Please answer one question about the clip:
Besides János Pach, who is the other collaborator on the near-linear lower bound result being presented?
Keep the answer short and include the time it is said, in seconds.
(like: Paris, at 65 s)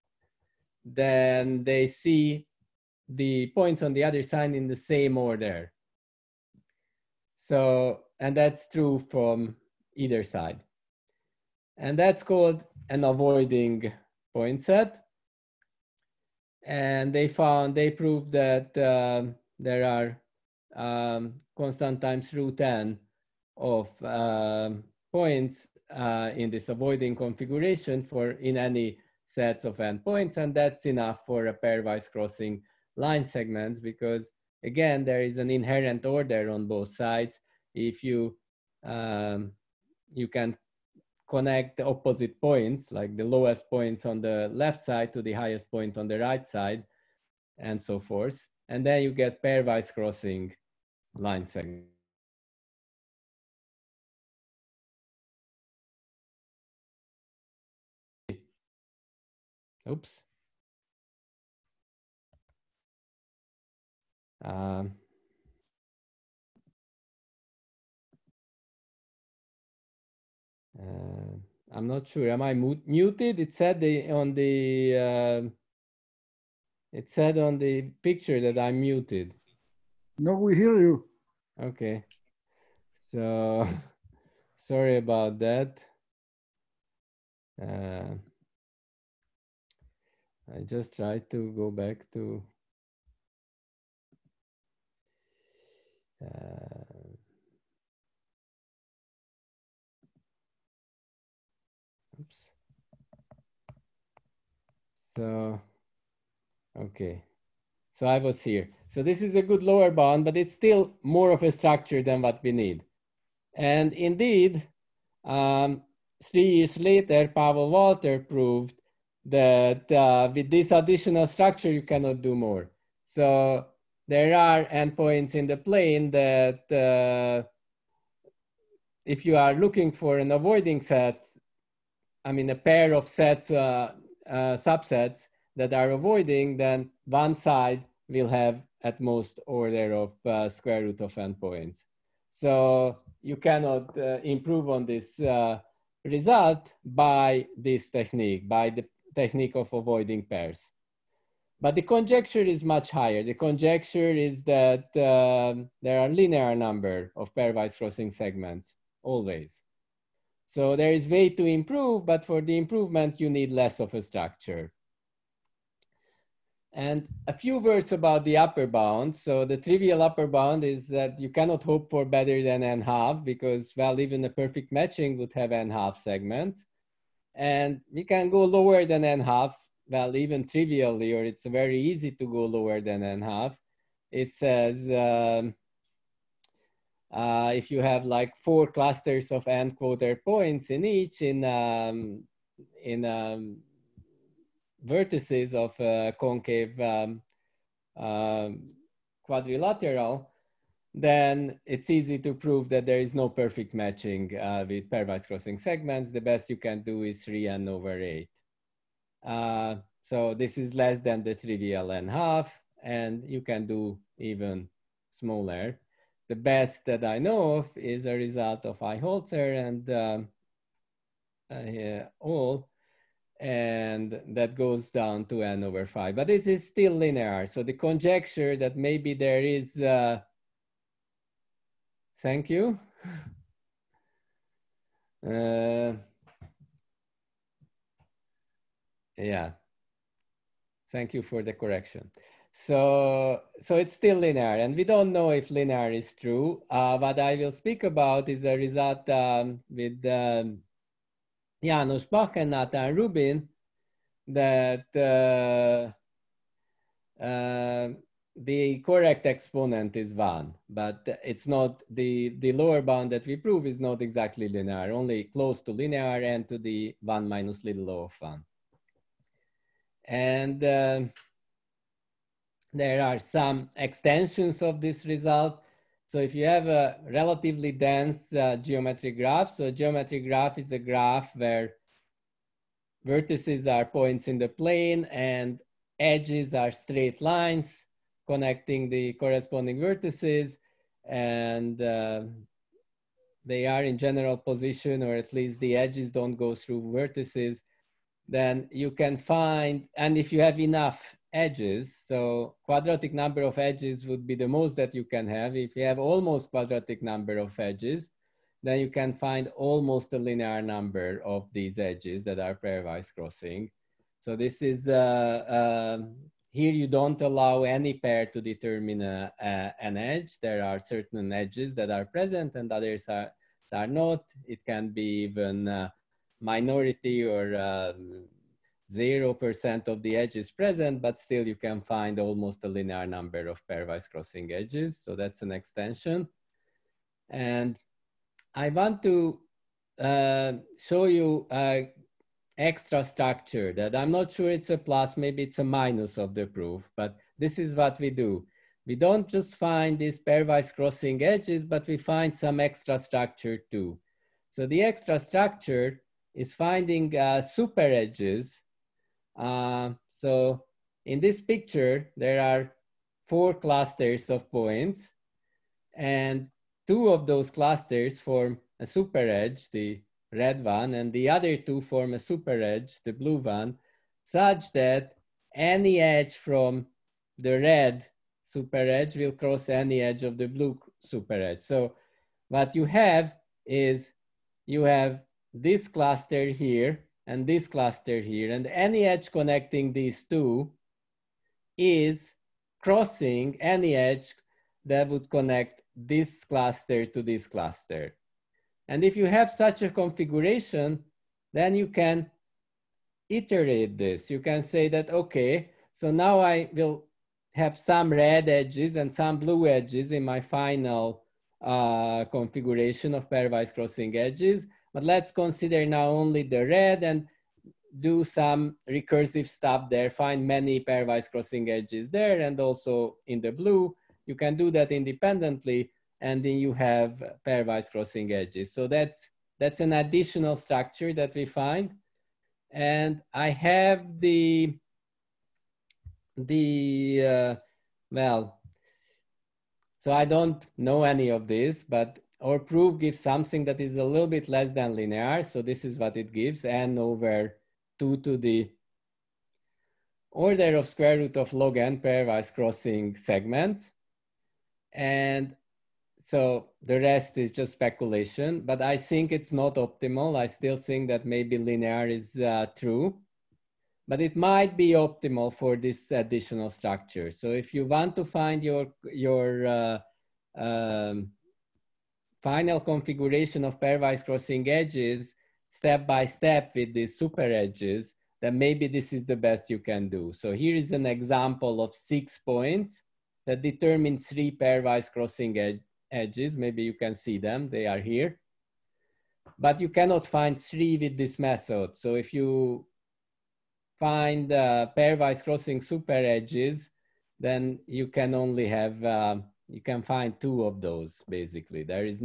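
Natan Rubin, at 252 s.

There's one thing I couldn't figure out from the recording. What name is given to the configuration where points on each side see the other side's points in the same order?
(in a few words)
avoiding point set.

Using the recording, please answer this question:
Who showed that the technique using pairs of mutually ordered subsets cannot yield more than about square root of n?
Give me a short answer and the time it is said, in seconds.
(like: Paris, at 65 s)
Pavel Valtr, at 117 s.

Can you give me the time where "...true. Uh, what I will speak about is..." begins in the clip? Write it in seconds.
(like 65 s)
246 s.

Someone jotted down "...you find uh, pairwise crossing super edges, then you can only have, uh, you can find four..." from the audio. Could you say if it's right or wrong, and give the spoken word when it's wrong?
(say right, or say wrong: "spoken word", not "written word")
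wrong: "two", not "four".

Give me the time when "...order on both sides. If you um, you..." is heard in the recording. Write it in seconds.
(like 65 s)
36 s.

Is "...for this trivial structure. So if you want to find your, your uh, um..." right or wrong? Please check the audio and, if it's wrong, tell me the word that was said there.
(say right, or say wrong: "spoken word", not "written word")
wrong: "additional", not "trivial".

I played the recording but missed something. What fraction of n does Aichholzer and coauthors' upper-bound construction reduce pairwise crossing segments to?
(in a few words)
n/5.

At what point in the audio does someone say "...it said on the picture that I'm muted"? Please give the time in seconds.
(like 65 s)
76 s.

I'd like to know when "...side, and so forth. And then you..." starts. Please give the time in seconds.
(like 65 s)
46 s.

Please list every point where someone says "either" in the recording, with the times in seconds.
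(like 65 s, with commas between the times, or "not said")
9 s.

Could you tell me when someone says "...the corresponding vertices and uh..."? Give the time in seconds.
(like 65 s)
288 s.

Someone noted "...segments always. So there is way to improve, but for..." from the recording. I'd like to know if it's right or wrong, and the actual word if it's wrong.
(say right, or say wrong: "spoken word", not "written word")
right.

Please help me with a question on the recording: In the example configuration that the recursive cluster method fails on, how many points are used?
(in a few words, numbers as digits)
6.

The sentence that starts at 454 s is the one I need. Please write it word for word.
And so the rest is just speculation, but I think it's not optimal.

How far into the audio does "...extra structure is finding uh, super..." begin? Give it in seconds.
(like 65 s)
354 s.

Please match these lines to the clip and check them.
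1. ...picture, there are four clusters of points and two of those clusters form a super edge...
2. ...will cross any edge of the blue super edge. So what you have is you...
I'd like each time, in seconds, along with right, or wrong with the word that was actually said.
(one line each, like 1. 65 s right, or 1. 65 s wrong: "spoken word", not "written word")
1. 361 s right
2. 379 s right.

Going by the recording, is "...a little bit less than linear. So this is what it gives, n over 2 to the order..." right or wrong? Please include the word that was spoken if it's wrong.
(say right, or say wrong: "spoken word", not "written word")
right.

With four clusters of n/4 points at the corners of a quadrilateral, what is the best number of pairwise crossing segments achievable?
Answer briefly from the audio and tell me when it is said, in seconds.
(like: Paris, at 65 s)
3n/8, at 207 s.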